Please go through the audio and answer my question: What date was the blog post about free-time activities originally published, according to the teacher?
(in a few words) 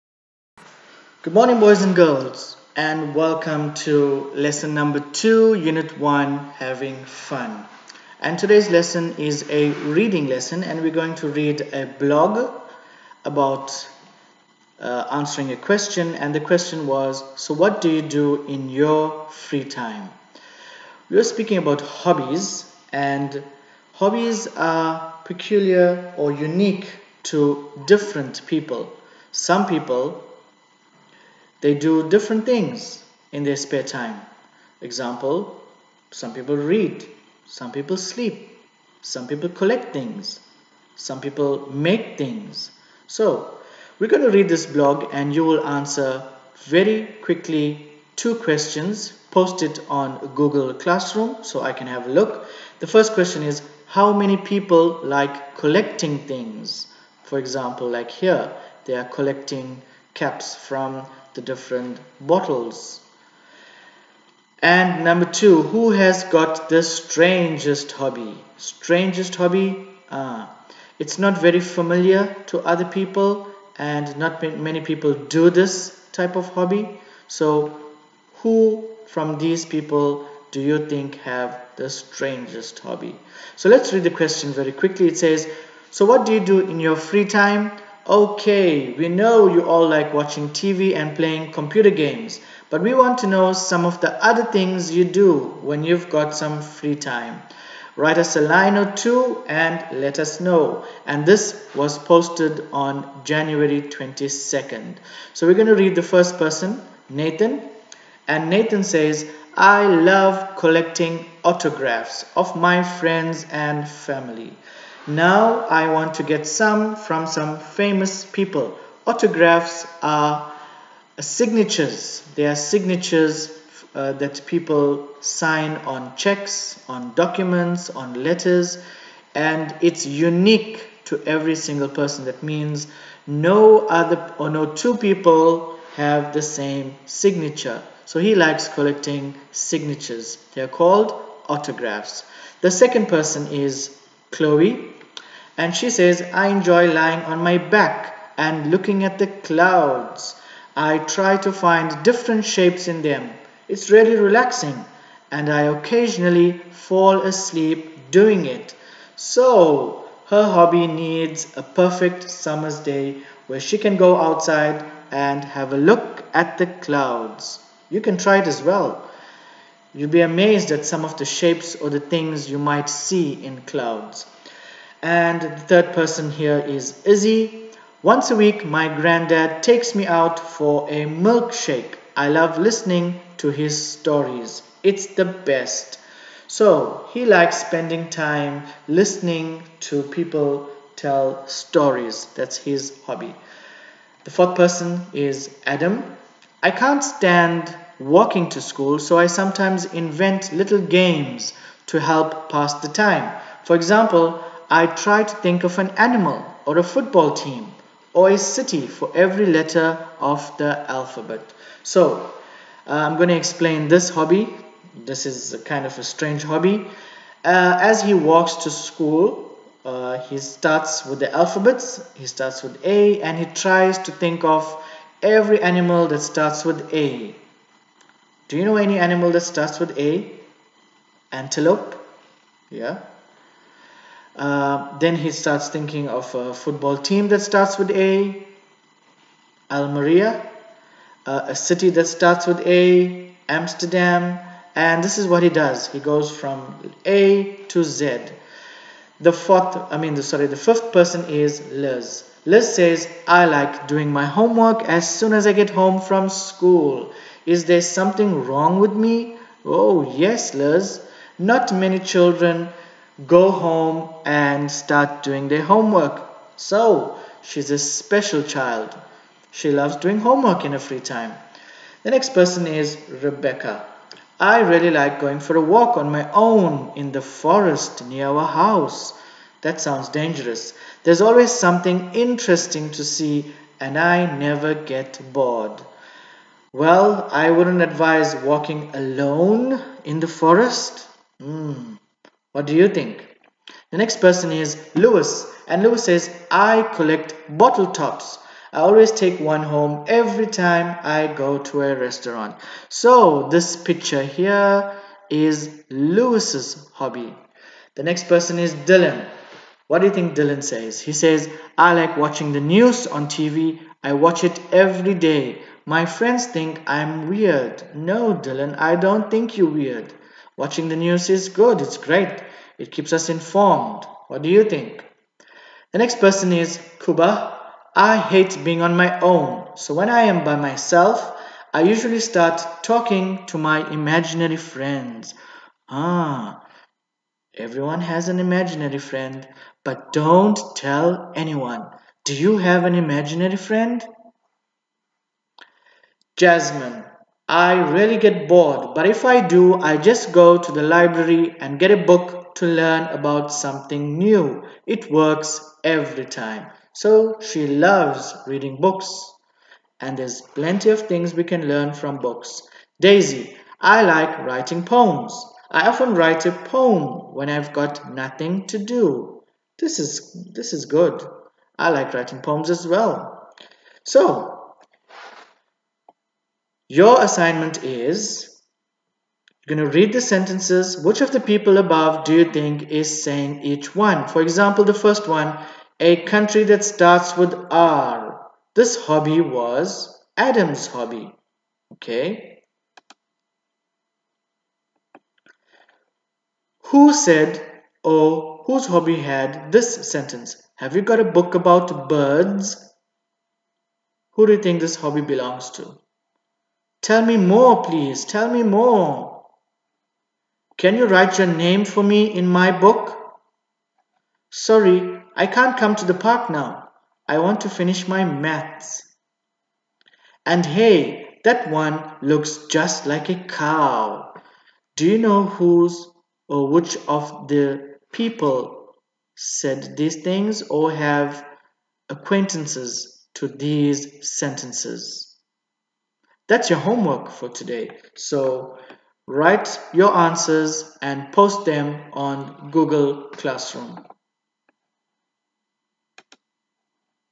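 January 22nd.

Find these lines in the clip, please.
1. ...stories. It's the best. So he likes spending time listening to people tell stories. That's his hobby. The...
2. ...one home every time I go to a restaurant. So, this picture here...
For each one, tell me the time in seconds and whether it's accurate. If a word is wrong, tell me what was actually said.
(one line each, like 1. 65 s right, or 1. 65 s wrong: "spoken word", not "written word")
1. 183 s right
2. 299 s right.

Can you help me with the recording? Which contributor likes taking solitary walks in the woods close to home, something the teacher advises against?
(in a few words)
Rebecca.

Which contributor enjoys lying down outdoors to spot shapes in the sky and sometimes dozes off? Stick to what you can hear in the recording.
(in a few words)
Chloe.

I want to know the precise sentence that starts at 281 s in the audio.
There's always something interesting to see, and I never get bored.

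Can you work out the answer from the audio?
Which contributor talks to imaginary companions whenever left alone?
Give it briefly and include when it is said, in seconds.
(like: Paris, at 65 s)
Kuba, at 327 s.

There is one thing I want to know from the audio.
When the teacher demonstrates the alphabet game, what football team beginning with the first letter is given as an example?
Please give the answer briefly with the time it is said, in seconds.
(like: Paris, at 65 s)
Almeria, at 239 s.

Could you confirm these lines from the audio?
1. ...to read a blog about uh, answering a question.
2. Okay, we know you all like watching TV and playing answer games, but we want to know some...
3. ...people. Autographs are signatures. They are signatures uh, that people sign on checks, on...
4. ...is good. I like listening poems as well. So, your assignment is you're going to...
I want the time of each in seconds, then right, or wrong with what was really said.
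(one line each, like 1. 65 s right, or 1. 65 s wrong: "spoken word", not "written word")
1. 11 s right
2. 88 s wrong: "computer", not "answer"
3. 118 s right
4. 370 s wrong: "writing", not "listening".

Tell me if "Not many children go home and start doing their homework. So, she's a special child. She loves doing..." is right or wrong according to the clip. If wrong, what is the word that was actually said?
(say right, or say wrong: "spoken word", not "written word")
right.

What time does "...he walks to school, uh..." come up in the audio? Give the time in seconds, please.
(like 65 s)
218 s.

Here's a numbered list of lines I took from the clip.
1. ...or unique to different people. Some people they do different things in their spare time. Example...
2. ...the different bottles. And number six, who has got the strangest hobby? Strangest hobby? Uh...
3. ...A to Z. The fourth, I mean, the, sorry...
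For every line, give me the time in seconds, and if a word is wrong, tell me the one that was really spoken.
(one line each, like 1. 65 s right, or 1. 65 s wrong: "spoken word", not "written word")
1. 26 s right
2. 61 s wrong: "two", not "six"
3. 247 s right.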